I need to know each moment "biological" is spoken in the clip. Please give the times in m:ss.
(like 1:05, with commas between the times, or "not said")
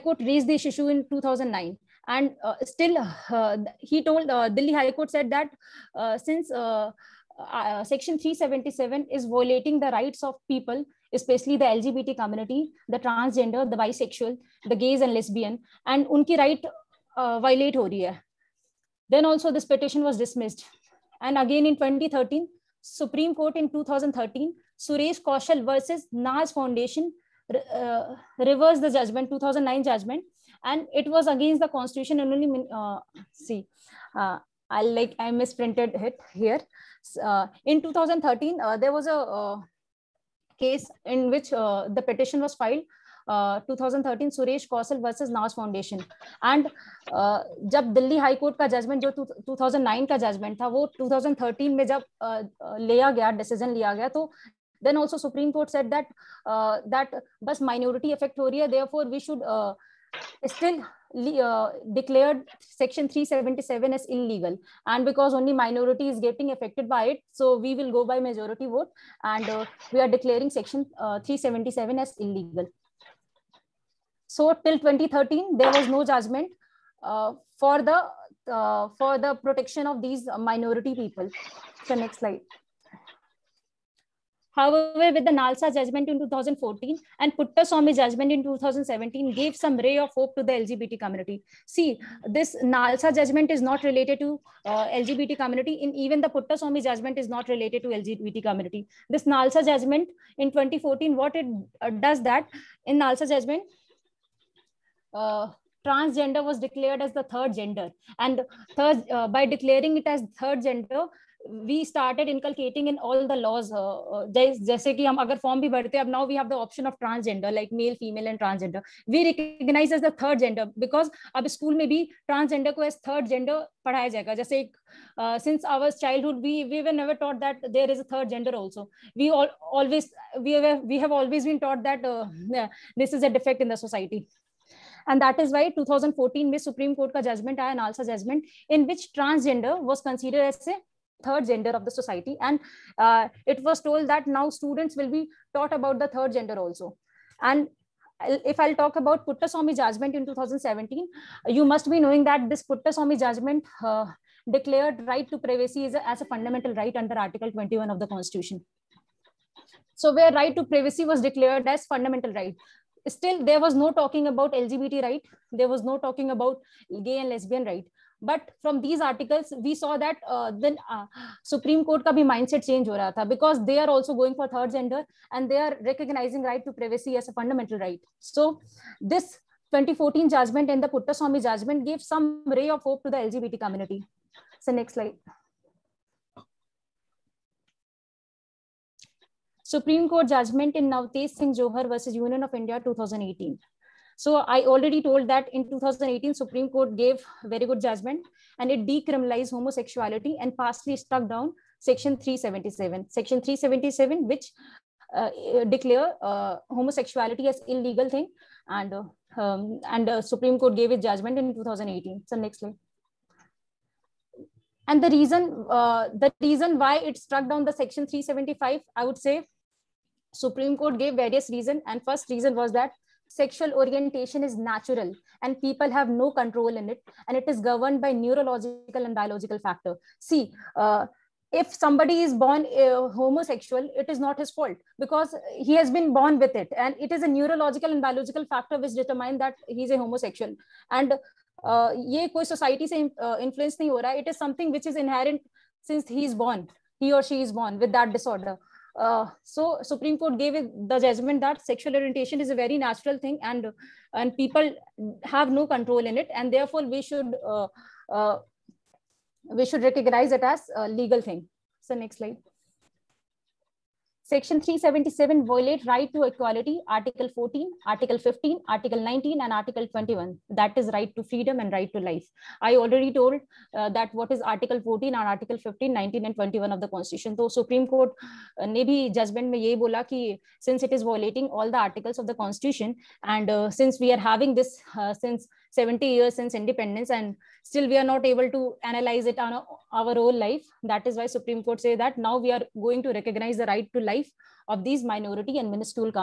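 3:49, 3:58.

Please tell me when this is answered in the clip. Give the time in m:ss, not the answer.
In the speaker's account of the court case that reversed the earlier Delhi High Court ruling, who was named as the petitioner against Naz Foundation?
0:24.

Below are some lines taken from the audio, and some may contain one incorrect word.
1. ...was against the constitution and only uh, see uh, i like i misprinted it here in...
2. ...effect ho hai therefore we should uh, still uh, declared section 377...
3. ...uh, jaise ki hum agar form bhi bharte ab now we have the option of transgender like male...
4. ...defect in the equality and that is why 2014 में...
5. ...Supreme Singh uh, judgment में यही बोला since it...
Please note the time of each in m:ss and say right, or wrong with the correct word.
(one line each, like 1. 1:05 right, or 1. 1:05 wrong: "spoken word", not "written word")
1. 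0:31 right
2. 0:58 right
3. 1:54 right
4. 2:13 wrong: "society", not "equality"
5. 4:37 wrong: "Court", not "Singh".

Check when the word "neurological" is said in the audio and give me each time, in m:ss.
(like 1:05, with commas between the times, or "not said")
3:48, 3:57.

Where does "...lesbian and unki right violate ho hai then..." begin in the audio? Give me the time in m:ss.
0:15.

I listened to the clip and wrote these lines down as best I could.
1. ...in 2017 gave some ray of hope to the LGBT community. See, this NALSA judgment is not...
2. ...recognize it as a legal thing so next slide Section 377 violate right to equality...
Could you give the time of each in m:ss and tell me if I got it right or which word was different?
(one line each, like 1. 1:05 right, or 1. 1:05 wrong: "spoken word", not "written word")
1. 1:28 right
2. 4:19 right.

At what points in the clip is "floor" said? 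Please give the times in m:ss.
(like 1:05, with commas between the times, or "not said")
not said.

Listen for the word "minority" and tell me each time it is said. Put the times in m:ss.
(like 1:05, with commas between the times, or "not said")
0:57, 1:05, 1:20, 4:55.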